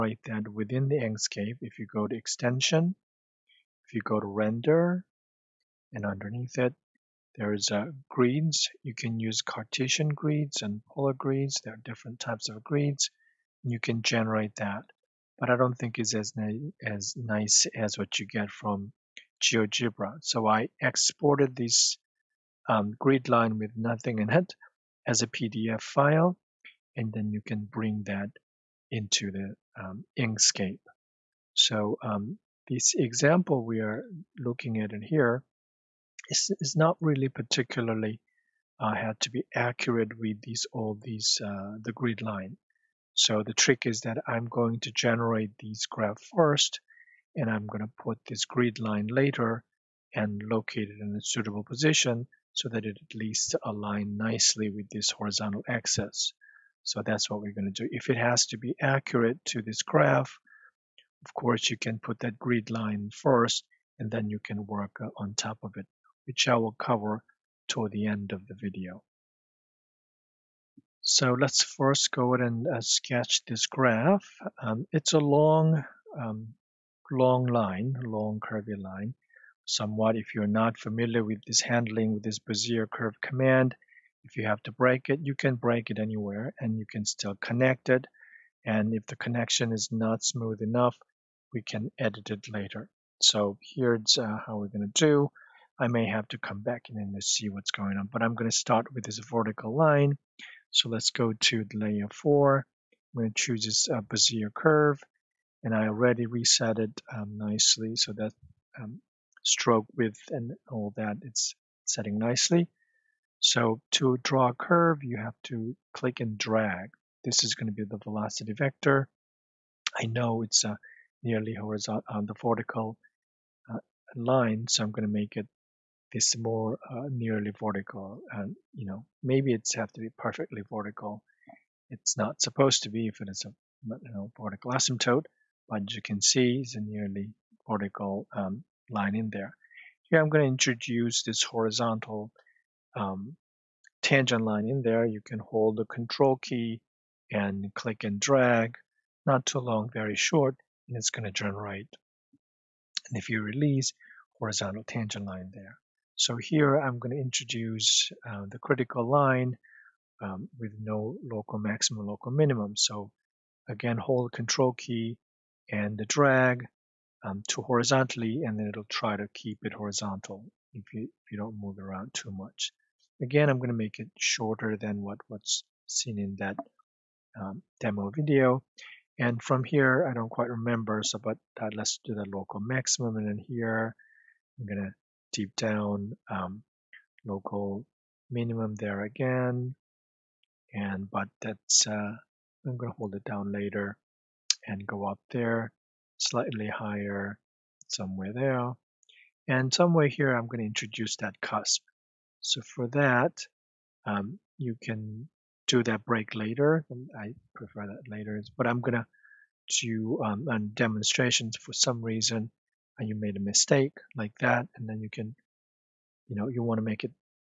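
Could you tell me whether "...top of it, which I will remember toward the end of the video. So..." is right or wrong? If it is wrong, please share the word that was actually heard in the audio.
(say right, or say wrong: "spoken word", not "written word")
wrong: "cover", not "remember".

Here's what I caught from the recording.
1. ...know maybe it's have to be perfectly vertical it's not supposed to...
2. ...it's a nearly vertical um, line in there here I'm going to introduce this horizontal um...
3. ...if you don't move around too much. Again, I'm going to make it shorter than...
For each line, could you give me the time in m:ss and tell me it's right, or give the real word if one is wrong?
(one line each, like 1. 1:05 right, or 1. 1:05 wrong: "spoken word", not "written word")
1. 2:08 right
2. 2:16 right
3. 2:51 right.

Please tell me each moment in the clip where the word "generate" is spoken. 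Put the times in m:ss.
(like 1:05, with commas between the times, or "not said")
0:14, 0:44, 2:31.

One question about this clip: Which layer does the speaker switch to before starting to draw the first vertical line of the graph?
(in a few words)
Layer 4.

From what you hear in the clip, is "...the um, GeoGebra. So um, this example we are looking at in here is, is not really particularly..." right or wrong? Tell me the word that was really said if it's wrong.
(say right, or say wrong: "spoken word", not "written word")
wrong: "Inkscape", not "GeoGebra".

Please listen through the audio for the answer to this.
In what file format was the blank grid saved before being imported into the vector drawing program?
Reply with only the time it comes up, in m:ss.
0:25.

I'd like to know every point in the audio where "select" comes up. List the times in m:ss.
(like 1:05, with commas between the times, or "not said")
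not said.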